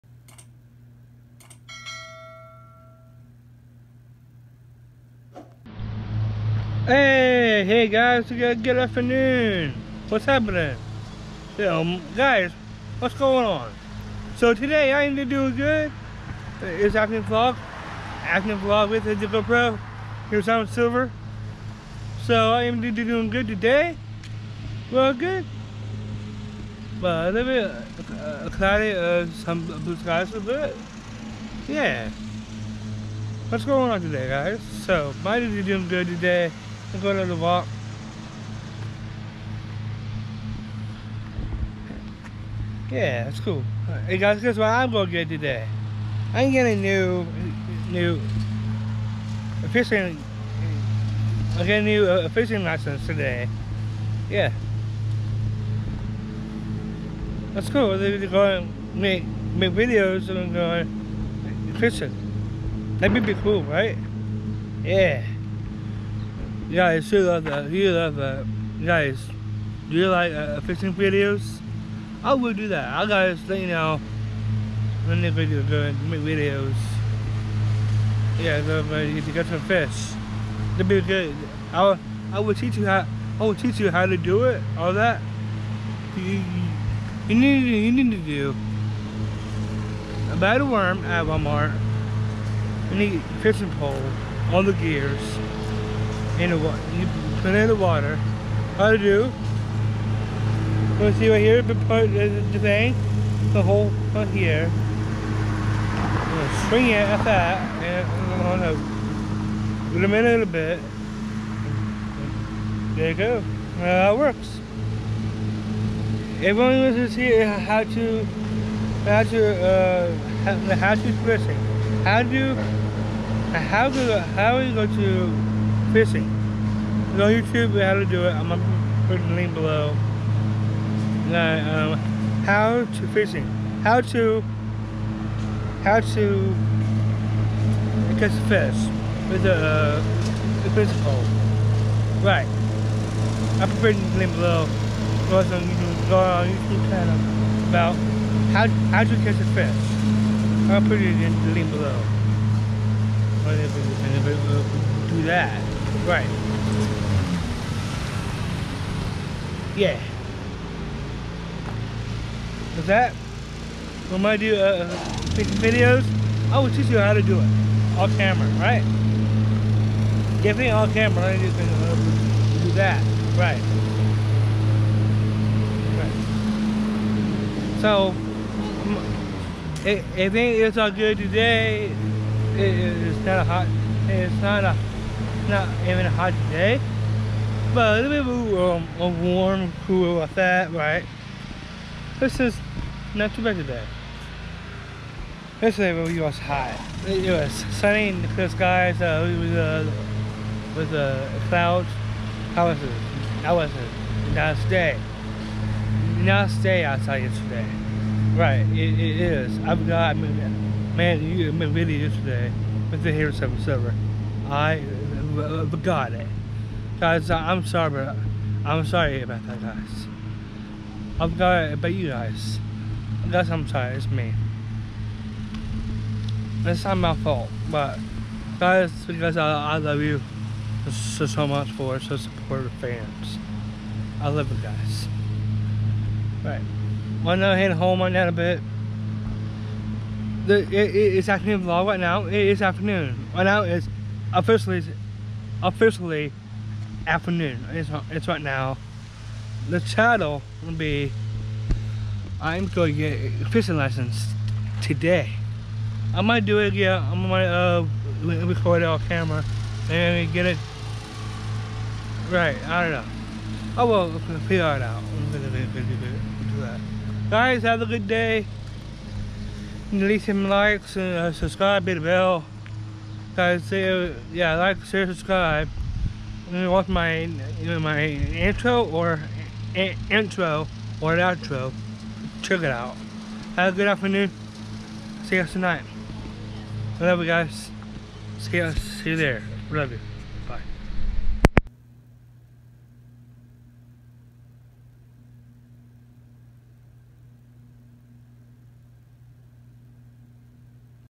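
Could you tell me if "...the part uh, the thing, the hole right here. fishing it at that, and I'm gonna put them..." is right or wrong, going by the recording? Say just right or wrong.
wrong.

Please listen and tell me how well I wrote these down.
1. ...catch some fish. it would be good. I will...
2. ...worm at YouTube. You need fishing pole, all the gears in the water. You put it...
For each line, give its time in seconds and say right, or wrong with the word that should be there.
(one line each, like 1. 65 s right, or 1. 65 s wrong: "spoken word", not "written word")
1. 79 s right
2. 90 s wrong: "Walmart", not "YouTube".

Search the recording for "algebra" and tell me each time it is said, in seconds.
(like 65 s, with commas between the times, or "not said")
not said.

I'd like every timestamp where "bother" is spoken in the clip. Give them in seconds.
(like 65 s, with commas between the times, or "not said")
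not said.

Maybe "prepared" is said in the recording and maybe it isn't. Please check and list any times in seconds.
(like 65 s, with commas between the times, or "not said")
143 s.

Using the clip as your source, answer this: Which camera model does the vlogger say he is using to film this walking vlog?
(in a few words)
GoPro Hero 7 Silver.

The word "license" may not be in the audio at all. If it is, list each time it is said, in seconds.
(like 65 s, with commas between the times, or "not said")
52 s, 253 s.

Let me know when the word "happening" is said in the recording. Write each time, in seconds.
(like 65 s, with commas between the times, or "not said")
10 s.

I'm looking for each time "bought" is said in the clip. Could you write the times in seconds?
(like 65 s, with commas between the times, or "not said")
90 s.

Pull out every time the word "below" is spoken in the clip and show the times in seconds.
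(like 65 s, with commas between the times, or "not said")
129 s, 144 s, 151 s.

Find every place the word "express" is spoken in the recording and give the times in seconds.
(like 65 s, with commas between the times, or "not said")
121 s.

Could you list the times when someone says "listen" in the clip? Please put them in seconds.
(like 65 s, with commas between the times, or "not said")
not said.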